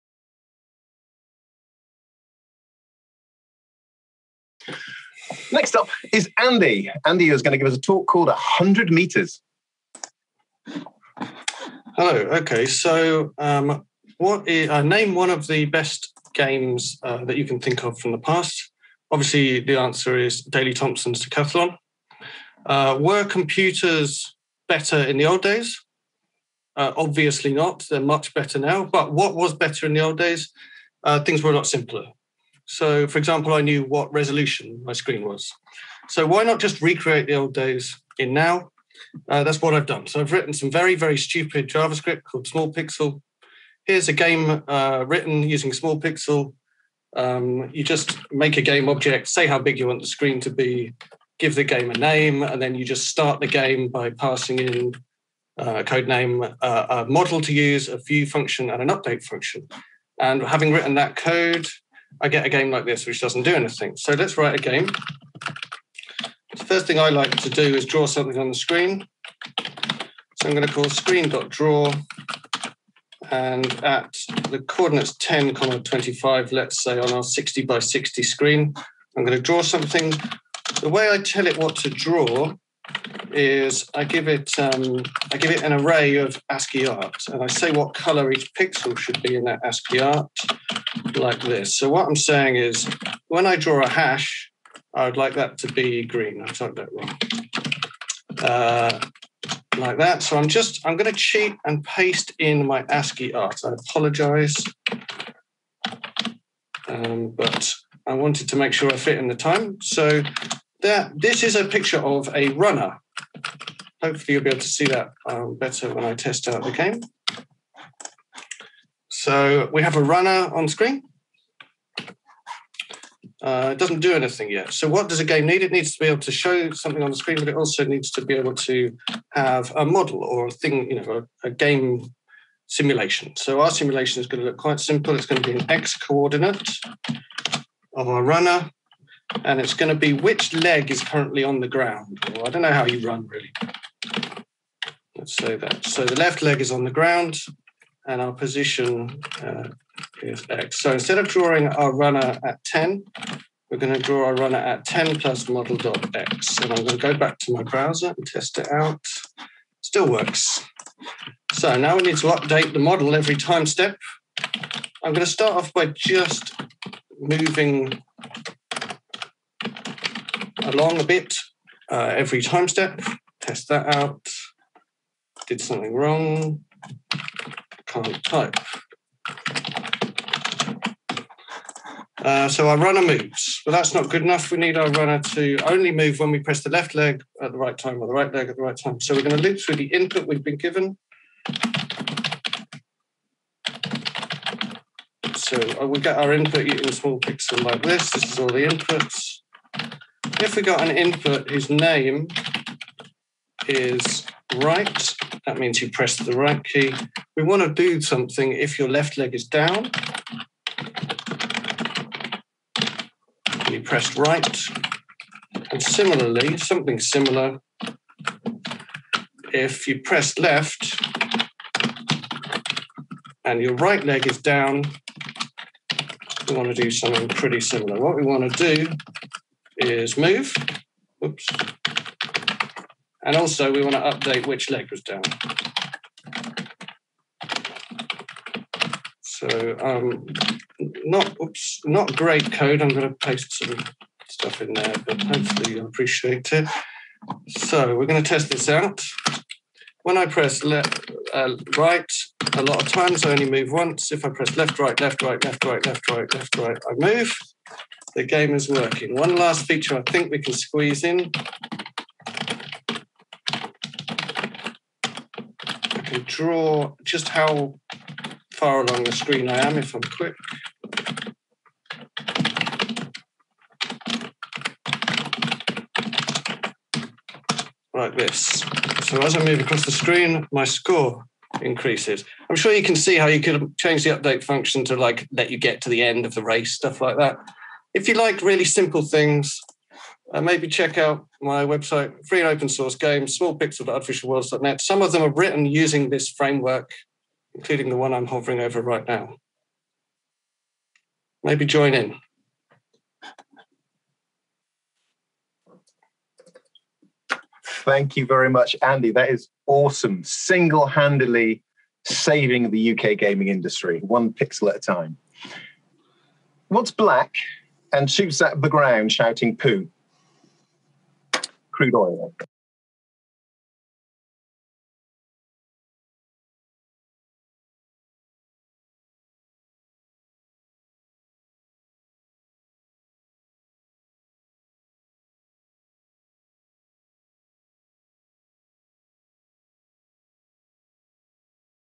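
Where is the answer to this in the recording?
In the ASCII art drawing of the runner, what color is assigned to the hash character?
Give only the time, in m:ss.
1:36.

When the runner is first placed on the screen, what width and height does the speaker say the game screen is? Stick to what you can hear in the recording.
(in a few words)
60 by 60.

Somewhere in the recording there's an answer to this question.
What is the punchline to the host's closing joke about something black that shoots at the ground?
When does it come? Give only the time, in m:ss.
5:21.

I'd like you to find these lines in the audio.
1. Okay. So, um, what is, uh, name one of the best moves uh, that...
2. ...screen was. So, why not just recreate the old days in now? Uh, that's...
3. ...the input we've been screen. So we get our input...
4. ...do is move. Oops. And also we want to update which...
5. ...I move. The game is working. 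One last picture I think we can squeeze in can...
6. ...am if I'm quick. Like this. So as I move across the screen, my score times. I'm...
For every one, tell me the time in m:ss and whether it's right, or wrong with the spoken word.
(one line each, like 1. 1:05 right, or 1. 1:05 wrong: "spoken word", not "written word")
1. 0:12 wrong: "games", not "moves"
2. 0:34 right
3. 3:09 wrong: "given", not "screen"
4. 3:48 right
5. 4:16 wrong: "feature", not "picture"
6. 4:29 wrong: "increases", not "times".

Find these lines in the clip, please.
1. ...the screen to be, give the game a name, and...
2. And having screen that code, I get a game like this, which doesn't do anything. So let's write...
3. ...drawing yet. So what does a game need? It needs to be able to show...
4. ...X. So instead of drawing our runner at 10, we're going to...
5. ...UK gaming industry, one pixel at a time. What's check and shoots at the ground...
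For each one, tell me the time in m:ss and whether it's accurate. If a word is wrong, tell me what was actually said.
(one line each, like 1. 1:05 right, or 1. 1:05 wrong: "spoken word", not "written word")
1. 0:50 right
2. 1:00 wrong: "written", not "screen"
3. 2:04 wrong: "anything", not "drawing"
4. 2:30 right
5. 5:12 wrong: "black", not "check".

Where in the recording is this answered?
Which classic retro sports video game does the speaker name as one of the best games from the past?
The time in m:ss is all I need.
0:20.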